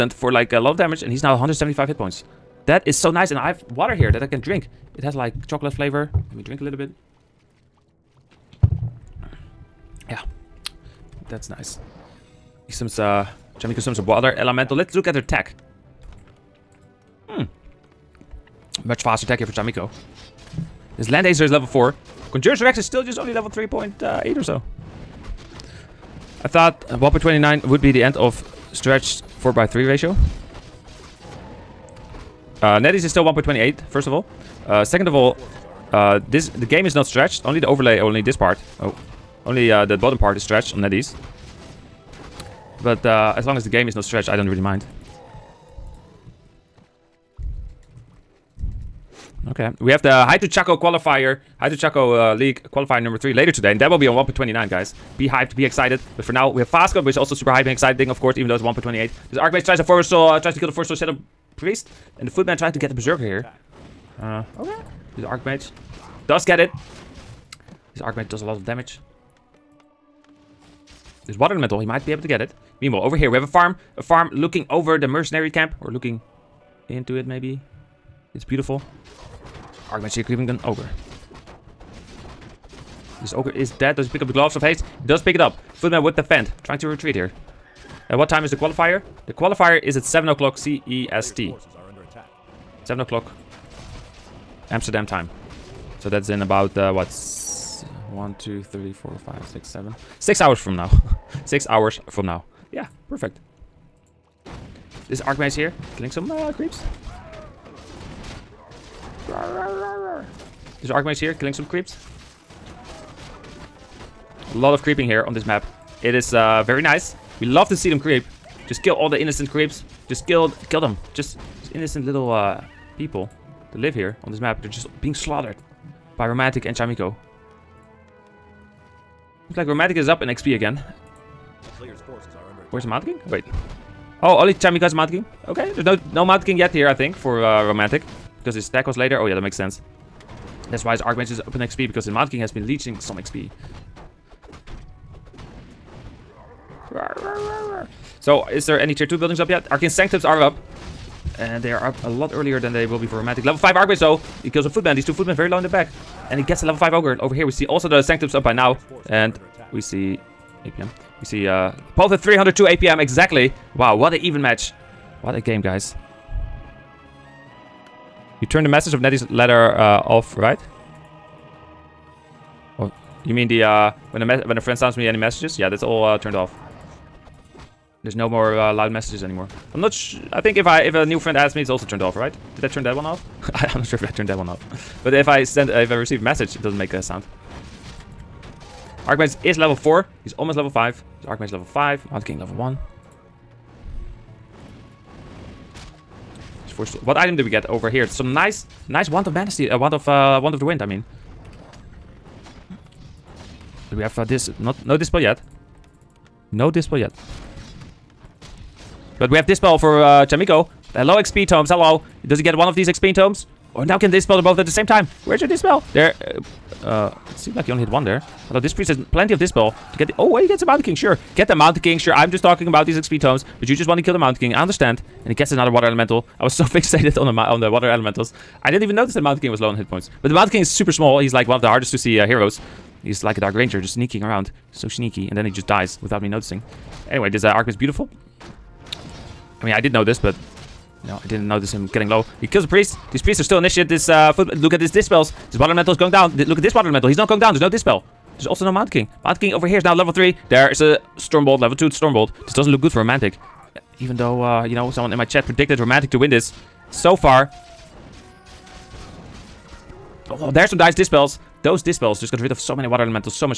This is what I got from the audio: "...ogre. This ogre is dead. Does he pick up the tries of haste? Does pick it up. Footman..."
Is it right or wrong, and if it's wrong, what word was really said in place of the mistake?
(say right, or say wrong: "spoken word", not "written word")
wrong: "gloves", not "tries".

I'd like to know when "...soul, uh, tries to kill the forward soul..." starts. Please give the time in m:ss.
1:00.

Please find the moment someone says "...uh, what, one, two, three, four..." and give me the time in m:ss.
1:36.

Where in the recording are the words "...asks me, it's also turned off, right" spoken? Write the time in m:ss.
3:01.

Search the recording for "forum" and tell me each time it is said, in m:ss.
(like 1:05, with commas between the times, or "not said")
not said.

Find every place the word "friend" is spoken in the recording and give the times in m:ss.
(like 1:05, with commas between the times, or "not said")
2:54, 3:01.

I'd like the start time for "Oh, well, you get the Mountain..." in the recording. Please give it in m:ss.
3:40.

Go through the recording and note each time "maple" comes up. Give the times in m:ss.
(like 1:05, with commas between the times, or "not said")
not said.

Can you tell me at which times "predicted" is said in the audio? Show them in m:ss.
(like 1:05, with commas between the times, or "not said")
4:15.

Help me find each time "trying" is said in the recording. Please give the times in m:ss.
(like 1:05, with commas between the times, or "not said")
1:02, 1:26.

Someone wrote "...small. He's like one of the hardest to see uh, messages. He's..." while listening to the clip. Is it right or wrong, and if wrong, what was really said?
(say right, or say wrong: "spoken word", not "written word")
wrong: "heroes", not "messages".